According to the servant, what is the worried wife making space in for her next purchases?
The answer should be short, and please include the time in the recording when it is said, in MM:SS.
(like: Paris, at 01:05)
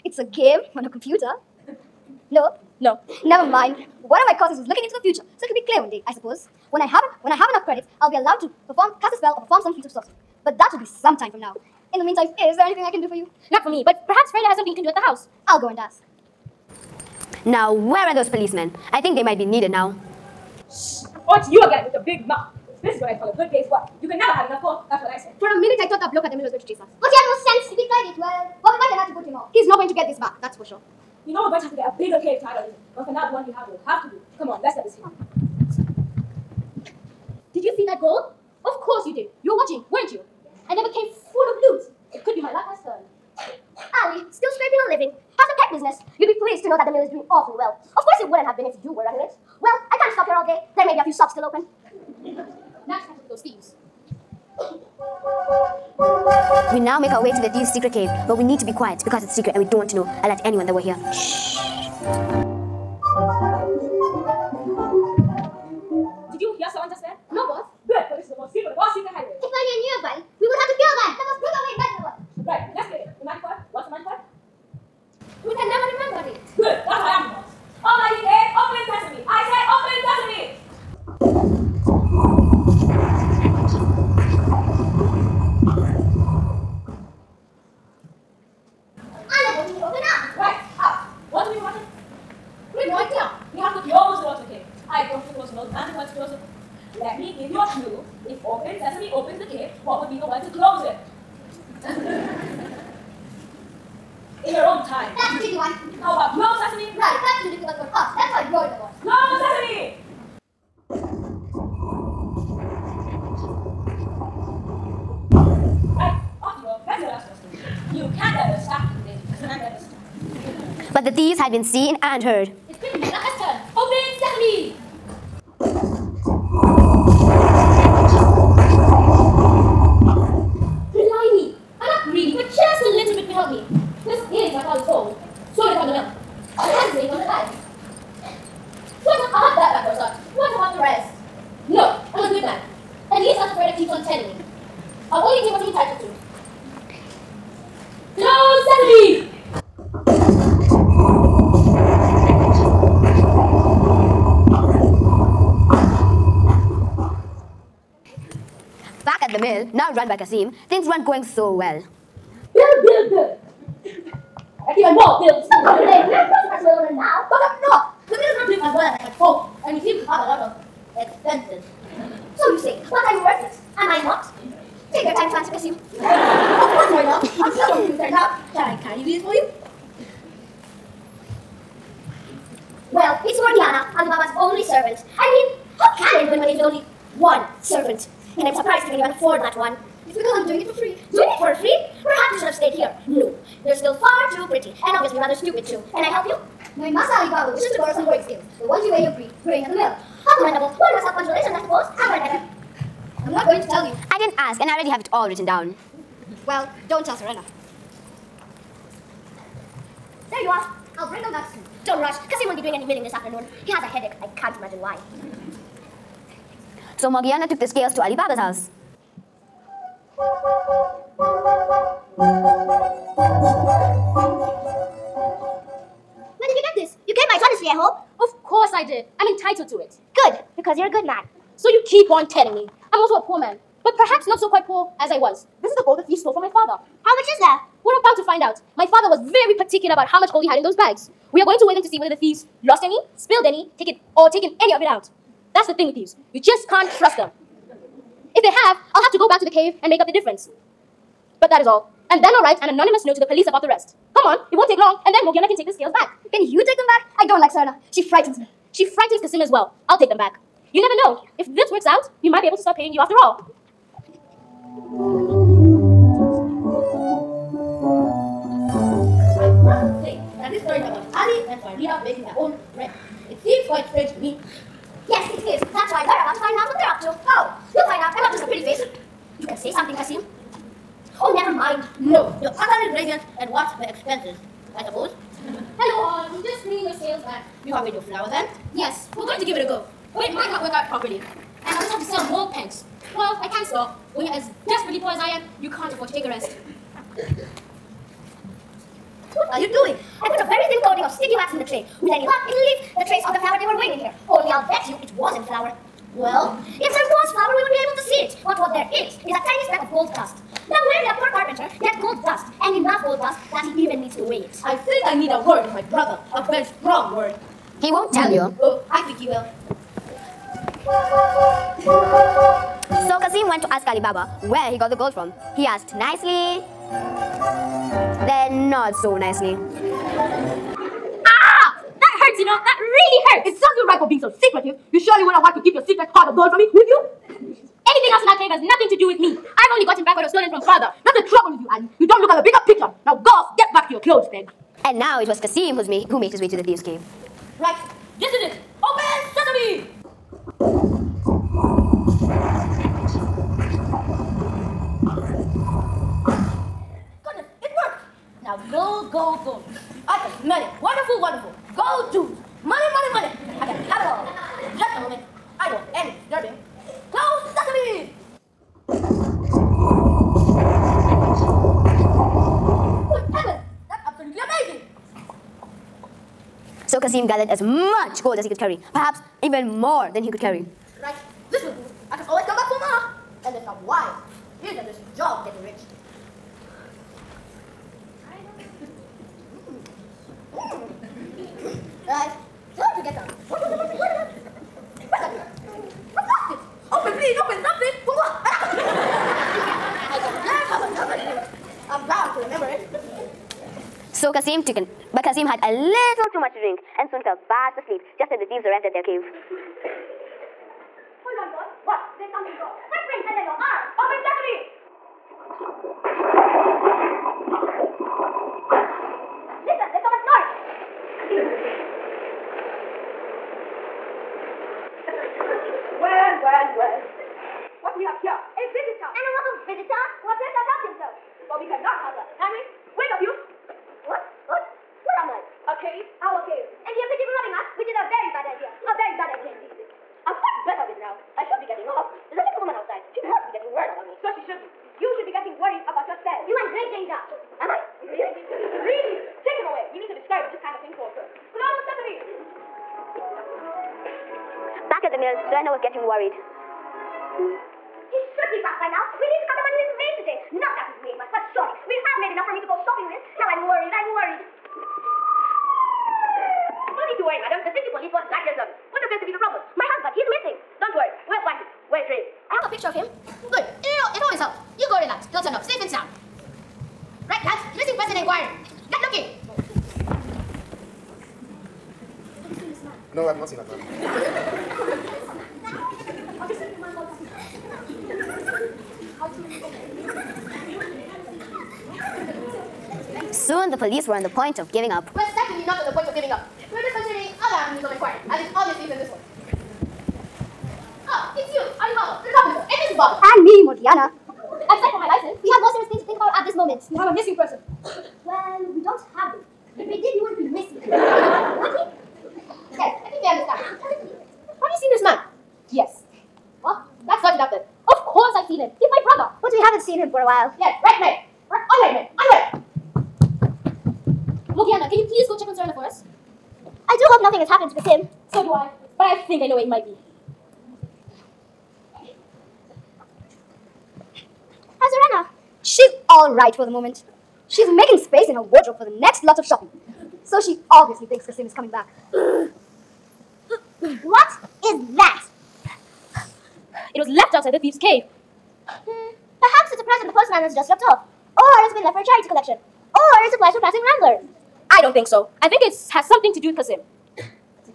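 Her wardrobe, at 08:58.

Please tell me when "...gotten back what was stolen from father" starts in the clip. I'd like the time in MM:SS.
05:39.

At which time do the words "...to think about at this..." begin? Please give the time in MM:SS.
08:26.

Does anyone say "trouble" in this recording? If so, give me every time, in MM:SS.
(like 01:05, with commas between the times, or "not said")
05:41.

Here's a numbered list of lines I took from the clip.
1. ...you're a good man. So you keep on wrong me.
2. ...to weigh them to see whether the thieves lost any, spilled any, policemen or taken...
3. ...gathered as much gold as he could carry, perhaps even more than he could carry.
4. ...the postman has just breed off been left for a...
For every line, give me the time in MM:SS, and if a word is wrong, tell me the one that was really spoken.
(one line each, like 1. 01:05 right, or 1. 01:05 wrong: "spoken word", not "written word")
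1. 03:50 wrong: "telling", not "wrong"
2. 04:01 wrong: "taken", not "policemen"
3. 06:17 right
4. 09:10 wrong: "dropped", not "breed".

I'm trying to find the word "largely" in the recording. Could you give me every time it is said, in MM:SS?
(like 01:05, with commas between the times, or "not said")
not said.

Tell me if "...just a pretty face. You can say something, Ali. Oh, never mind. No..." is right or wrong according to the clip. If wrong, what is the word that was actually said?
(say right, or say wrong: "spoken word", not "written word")
wrong: "Kasim", not "Ali".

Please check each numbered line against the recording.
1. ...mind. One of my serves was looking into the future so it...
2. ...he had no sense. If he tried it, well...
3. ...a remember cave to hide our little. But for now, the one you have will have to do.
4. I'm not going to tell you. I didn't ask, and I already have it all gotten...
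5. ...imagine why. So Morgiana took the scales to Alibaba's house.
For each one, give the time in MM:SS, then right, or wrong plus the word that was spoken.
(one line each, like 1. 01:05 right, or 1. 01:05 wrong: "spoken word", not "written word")
1. 00:03 wrong: "courses", not "serves"
2. 00:27 right
3. 00:31 wrong: "bigger", not "remember"
4. 03:23 wrong: "written", not "gotten"
5. 03:34 right.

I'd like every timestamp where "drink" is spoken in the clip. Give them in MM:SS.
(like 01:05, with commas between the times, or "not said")
06:41, 06:46.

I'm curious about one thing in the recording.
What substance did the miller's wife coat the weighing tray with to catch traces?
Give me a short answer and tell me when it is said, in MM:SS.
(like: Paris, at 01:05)
Sticky wax, at 05:01.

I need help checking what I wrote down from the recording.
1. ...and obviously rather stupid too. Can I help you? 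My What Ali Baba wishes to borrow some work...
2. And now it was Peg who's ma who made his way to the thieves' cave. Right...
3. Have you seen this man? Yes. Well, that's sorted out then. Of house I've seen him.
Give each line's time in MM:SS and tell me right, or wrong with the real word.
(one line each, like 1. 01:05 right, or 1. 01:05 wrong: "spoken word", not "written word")
1. 03:14 wrong: "Master", not "What"
2. 05:44 wrong: "Kasim", not "Peg"
3. 08:34 wrong: "course", not "house".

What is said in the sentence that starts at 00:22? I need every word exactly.
This is what I call a good day's work.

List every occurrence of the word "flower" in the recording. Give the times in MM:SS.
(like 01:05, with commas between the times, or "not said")
04:48, 05:03.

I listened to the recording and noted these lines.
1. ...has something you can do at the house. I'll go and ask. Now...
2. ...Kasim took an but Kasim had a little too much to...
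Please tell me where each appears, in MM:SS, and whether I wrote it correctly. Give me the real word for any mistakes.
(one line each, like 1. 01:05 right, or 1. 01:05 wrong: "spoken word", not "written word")
1. 00:14 right
2. 06:44 right.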